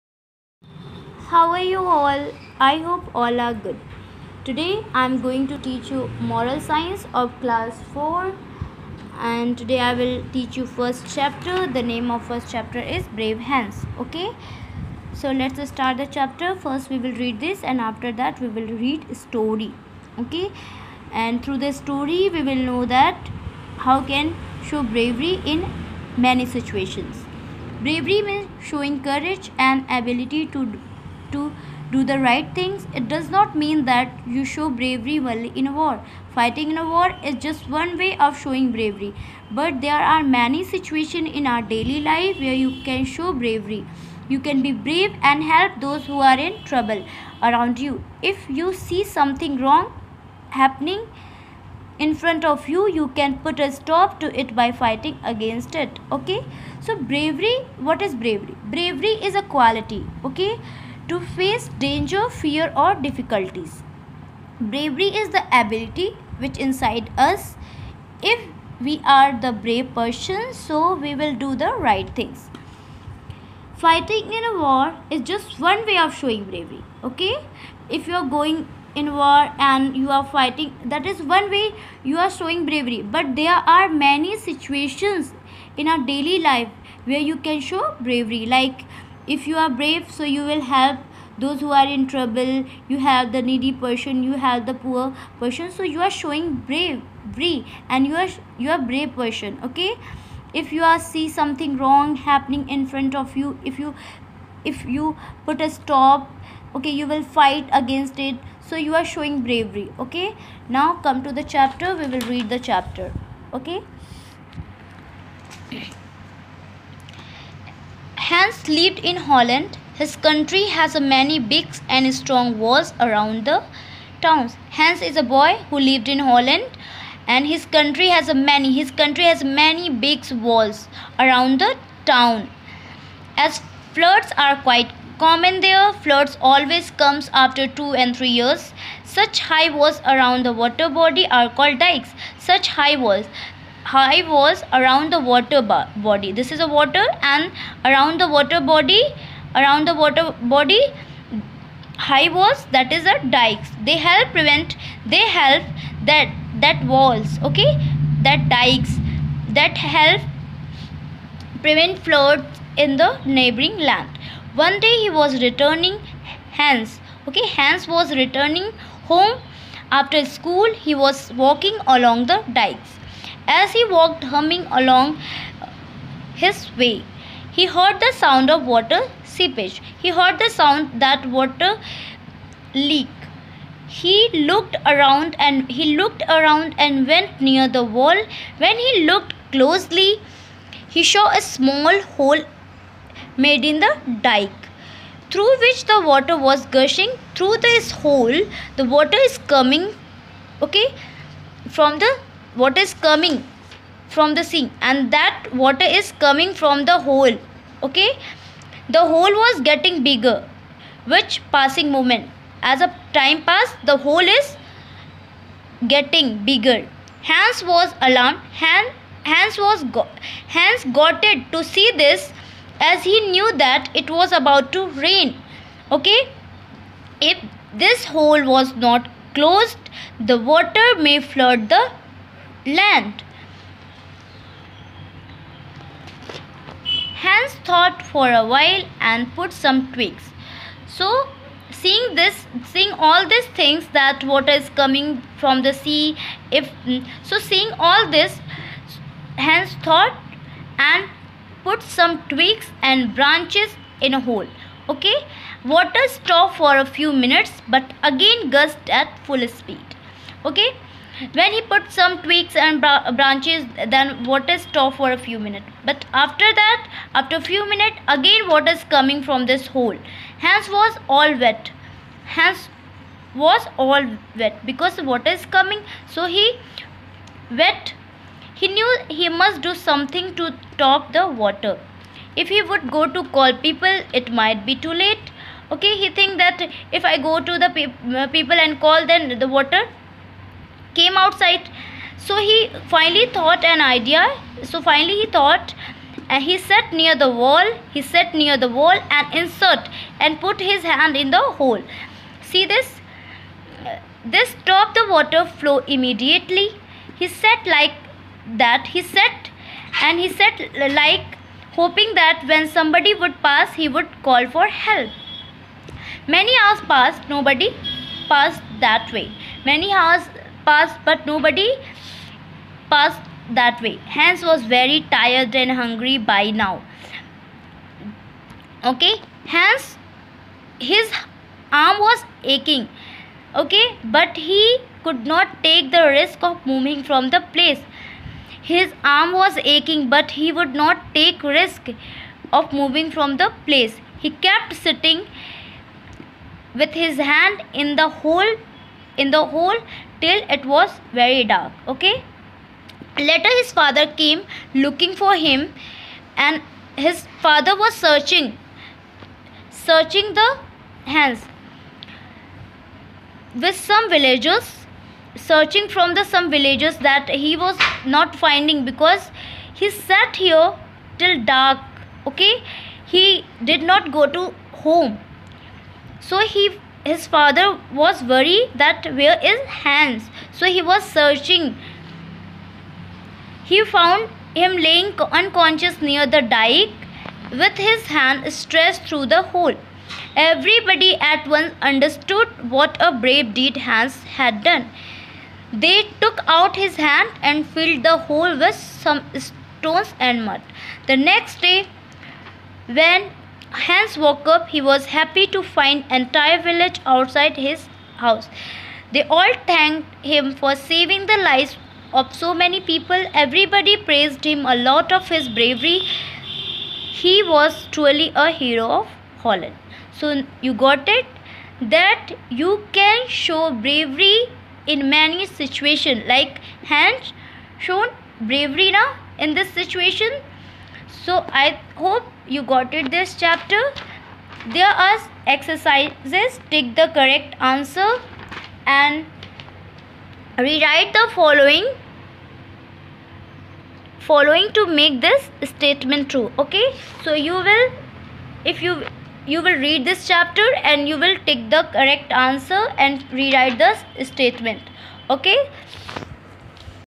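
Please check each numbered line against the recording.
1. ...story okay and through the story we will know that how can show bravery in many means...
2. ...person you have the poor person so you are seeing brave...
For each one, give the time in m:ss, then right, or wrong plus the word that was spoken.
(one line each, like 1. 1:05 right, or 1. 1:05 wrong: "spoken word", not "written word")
1. 0:19 wrong: "situations", not "means"
2. 1:33 wrong: "showing", not "seeing".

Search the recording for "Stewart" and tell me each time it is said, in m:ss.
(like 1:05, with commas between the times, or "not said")
not said.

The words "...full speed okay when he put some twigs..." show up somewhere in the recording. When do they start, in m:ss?
4:19.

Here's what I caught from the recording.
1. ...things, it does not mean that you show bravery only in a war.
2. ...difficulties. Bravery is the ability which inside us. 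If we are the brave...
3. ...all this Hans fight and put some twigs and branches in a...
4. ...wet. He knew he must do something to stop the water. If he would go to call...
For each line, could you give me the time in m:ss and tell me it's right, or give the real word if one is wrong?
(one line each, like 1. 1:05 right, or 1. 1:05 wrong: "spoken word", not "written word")
1. 0:32 right
2. 1:02 right
3. 4:07 wrong: "thought", not "fight"
4. 4:37 right.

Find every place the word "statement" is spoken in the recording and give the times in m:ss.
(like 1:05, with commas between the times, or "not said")
7:25, 7:34.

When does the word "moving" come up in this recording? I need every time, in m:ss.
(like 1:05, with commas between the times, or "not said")
5:36, 5:42.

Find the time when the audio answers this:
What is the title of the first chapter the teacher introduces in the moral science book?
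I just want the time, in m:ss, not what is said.
0:13.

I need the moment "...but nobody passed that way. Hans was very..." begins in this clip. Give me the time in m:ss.
5:21.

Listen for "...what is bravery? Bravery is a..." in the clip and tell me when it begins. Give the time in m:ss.
0:57.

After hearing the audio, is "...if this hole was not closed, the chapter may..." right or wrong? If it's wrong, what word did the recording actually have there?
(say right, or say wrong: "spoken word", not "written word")
wrong: "water", not "chapter".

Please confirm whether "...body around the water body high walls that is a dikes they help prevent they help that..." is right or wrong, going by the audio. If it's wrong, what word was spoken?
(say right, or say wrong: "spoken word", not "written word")
right.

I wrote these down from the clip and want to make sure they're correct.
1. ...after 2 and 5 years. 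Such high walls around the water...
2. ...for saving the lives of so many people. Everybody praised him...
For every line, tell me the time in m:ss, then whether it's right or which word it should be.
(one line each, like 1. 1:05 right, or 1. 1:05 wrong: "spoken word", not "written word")
1. 2:17 wrong: "3", not "5"
2. 6:50 right.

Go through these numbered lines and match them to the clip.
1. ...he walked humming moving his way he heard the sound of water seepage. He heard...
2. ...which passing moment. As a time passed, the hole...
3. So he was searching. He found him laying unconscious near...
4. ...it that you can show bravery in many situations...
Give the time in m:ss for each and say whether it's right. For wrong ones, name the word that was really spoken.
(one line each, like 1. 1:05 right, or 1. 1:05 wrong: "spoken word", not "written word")
1. 2:53 wrong: "along", not "moving"
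2. 3:31 right
3. 6:20 right
4. 7:01 right.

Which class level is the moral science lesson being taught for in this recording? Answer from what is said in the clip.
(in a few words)
Class 4.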